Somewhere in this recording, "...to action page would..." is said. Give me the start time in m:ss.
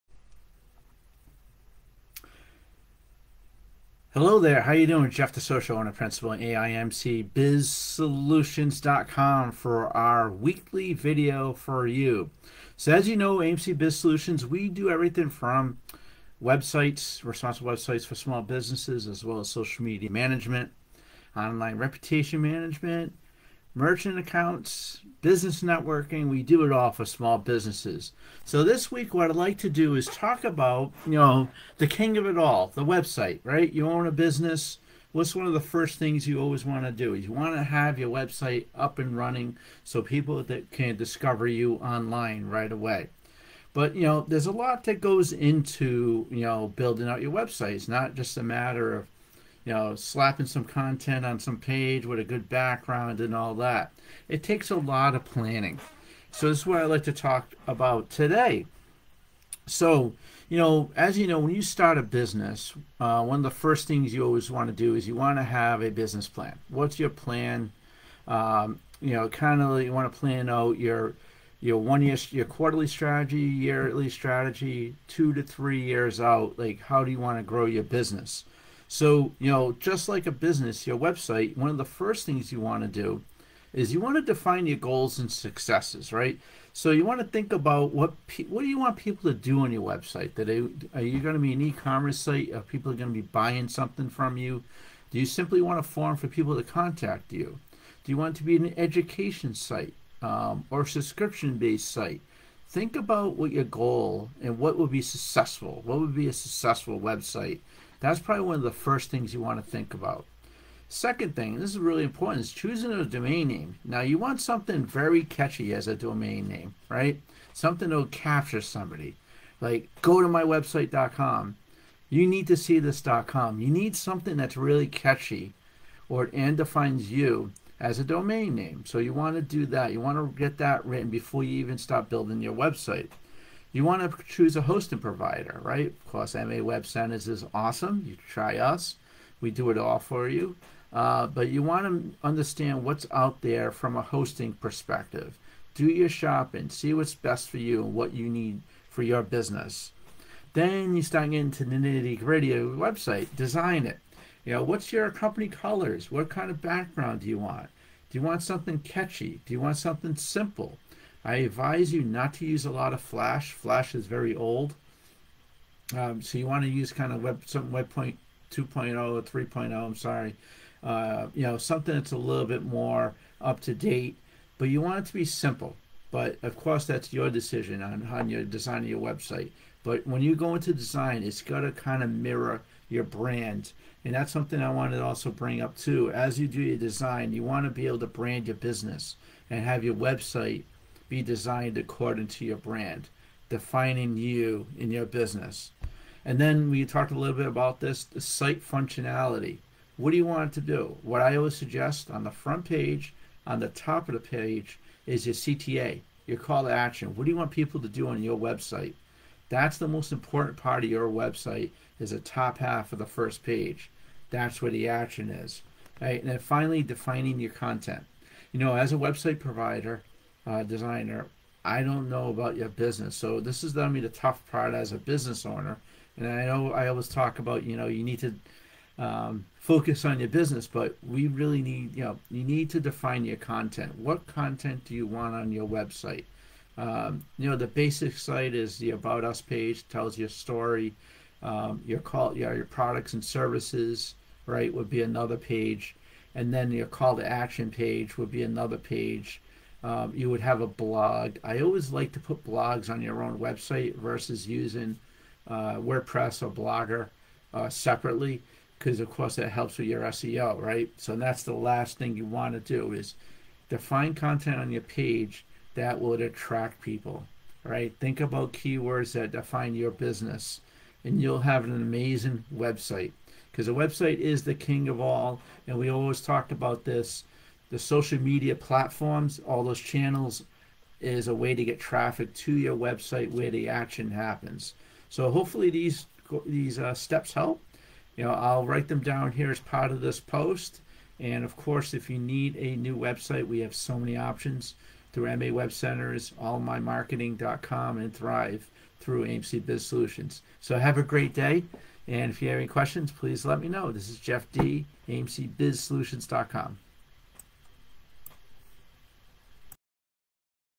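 4:07.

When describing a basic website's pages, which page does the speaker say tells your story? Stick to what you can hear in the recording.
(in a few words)
About Us.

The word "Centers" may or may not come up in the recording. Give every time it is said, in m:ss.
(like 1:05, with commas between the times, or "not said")
2:16, 4:55.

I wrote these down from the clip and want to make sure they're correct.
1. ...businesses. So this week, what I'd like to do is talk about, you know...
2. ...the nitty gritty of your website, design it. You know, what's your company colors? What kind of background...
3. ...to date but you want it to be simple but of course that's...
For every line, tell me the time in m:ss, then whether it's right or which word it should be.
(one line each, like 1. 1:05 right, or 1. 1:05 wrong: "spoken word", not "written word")
1. 0:27 right
2. 2:31 right
3. 2:53 right.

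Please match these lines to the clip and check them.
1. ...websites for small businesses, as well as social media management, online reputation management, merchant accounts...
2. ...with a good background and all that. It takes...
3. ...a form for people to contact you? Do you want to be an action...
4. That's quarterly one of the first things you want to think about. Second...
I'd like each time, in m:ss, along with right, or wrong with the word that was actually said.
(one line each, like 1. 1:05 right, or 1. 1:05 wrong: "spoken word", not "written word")
1. 0:17 right
2. 0:52 right
3. 1:35 wrong: "education", not "action"
4. 1:48 wrong: "probably", not "quarterly".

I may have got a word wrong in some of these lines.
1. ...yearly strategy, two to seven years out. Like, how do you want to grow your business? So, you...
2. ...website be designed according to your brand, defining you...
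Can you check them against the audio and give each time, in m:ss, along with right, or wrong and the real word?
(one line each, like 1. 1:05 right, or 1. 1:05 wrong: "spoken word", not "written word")
1. 1:13 wrong: "three", not "seven"
2. 3:09 right.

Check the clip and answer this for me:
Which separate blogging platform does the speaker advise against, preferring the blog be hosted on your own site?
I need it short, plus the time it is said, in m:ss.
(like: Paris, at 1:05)
WordPress, at 4:15.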